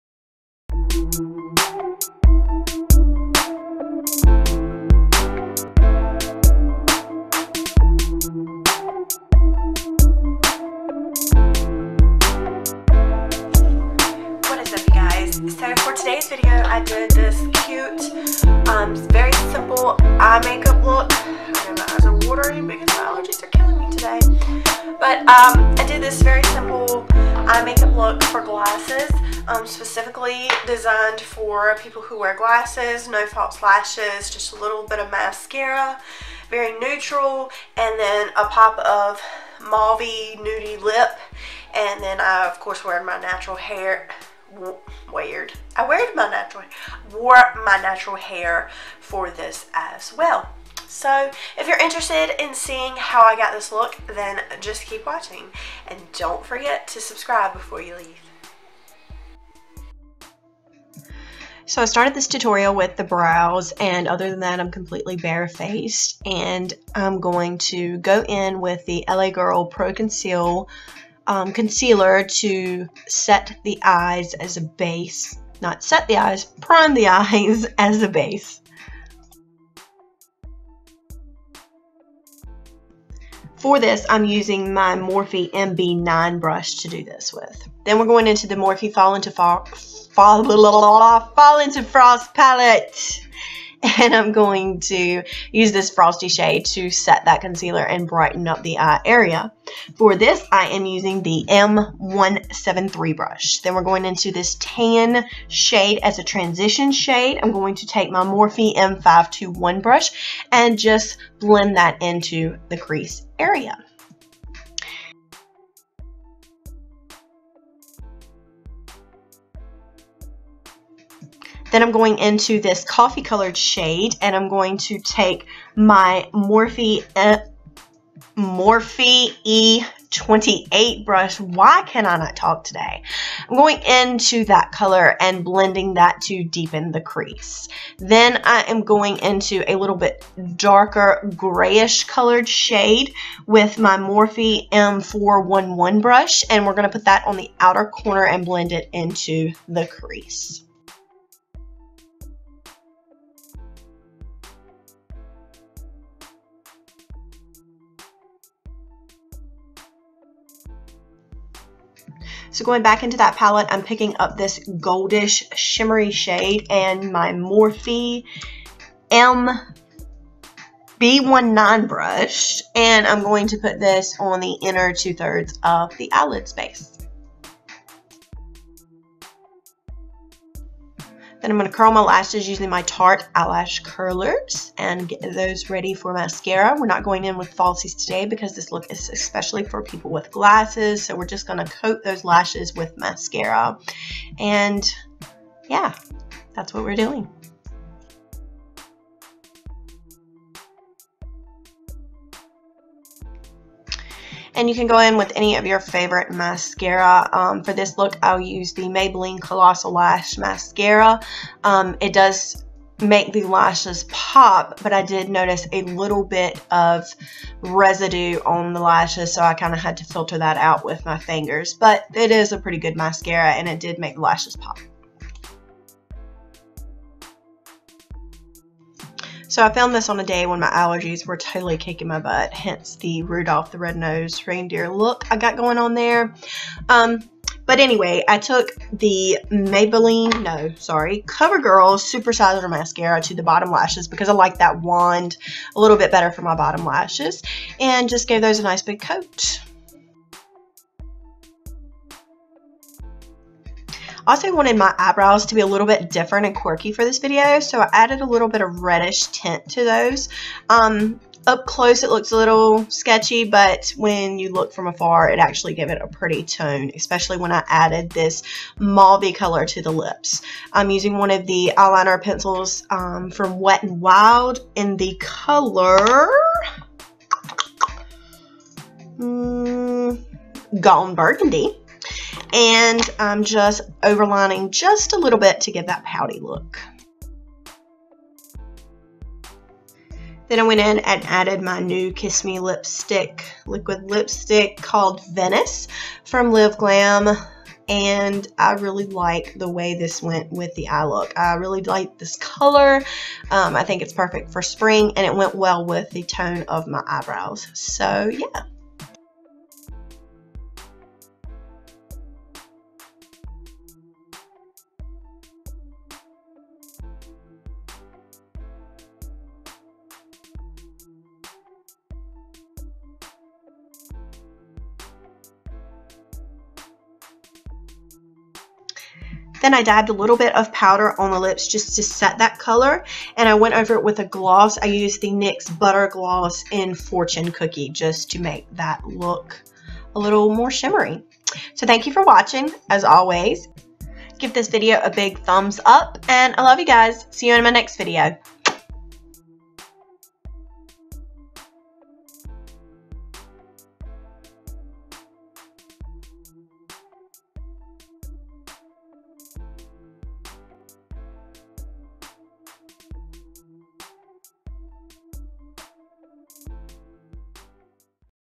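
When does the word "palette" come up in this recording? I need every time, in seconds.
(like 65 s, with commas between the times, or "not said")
92 s, 163 s.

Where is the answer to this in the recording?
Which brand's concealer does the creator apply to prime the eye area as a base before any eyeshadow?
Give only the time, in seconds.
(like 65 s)
69 s.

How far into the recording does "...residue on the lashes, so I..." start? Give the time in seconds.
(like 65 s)
217 s.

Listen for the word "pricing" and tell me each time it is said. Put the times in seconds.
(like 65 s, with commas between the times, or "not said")
not said.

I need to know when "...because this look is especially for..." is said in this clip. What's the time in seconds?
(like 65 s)
188 s.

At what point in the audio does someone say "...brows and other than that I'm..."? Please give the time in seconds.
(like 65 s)
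63 s.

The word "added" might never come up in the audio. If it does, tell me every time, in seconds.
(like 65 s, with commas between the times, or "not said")
257 s, 267 s, 291 s.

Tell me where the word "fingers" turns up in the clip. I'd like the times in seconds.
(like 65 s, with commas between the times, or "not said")
221 s.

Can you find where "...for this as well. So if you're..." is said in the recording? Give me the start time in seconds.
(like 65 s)
48 s.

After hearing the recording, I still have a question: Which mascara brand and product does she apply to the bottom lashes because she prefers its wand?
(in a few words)
CoverGirl Supersizer.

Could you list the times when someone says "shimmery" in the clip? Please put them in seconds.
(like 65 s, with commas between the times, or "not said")
165 s, 340 s.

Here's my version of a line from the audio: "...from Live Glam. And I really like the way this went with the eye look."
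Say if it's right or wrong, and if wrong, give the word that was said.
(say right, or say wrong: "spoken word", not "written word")
right.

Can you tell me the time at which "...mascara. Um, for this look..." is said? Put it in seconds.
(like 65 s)
206 s.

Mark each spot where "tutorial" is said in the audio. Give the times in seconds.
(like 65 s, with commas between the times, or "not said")
62 s.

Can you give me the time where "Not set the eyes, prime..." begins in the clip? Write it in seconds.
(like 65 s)
75 s.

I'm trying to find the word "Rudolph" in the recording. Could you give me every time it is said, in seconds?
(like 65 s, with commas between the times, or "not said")
233 s.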